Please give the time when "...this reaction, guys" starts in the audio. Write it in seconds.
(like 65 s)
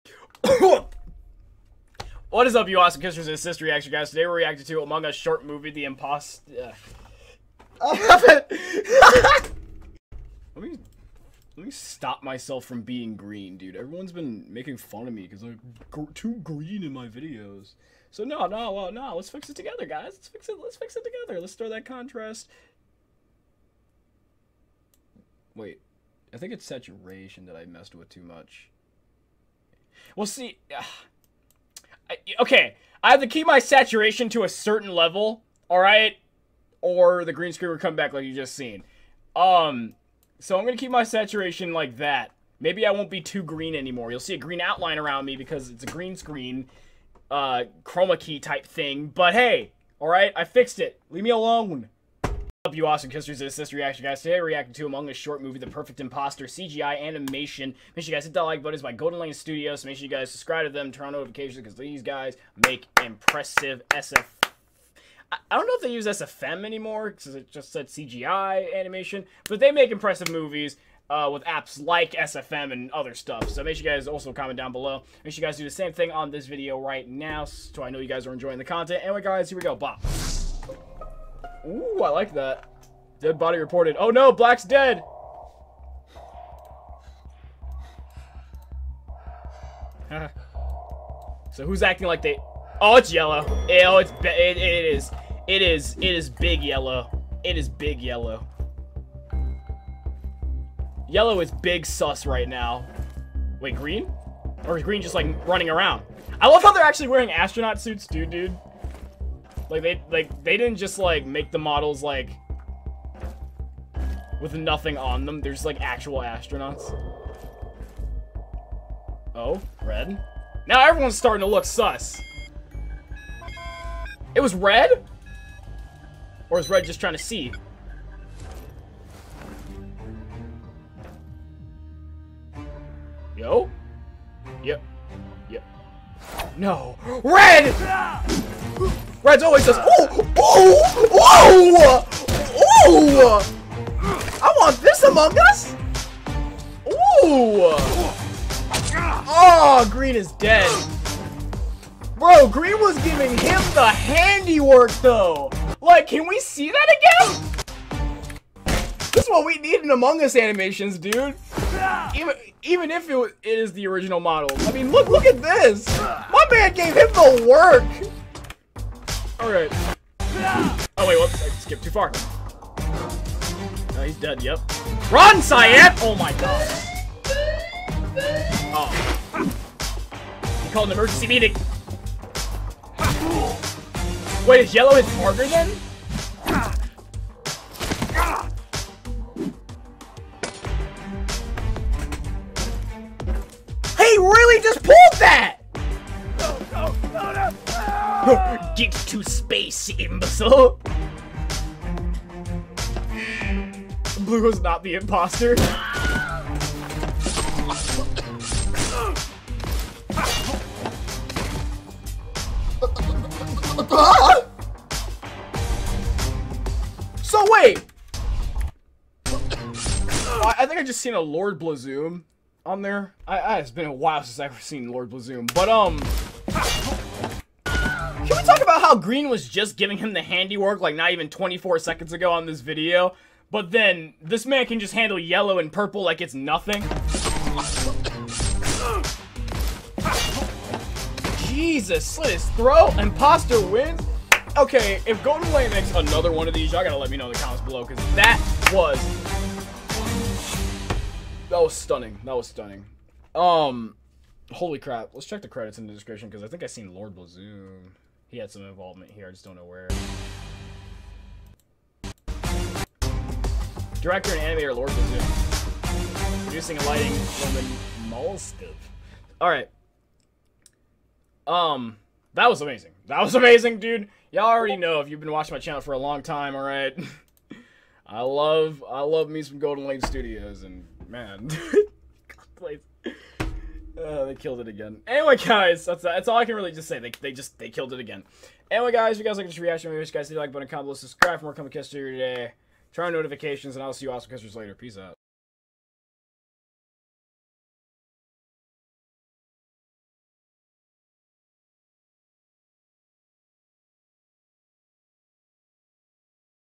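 53 s.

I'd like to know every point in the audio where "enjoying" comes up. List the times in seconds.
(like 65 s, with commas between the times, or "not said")
78 s.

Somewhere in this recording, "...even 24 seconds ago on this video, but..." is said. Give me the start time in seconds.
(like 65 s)
231 s.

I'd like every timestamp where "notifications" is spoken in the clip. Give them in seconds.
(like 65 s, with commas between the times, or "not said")
61 s, 293 s.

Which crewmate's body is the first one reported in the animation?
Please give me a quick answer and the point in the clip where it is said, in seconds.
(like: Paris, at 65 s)
Black, at 84 s.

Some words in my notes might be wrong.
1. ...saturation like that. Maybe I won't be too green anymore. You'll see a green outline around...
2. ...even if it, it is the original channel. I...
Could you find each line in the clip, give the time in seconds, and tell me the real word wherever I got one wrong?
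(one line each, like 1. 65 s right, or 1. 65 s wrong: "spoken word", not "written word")
1. 41 s right
2. 162 s wrong: "model", not "channel".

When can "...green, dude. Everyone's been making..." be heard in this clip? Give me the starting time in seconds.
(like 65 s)
13 s.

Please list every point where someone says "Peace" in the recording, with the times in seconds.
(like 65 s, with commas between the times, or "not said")
294 s.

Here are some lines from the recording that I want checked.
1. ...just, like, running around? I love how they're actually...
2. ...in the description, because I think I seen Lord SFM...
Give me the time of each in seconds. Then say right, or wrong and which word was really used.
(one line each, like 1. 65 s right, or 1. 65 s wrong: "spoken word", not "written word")
1. 105 s right
2. 255 s wrong: "Blazoo", not "SFM".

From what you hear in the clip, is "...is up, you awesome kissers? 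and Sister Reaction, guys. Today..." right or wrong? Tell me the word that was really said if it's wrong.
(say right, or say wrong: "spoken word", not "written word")
right.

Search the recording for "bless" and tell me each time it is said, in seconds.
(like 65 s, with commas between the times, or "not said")
282 s.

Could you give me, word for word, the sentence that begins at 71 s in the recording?
Uh, with apps like SFM and other stuff.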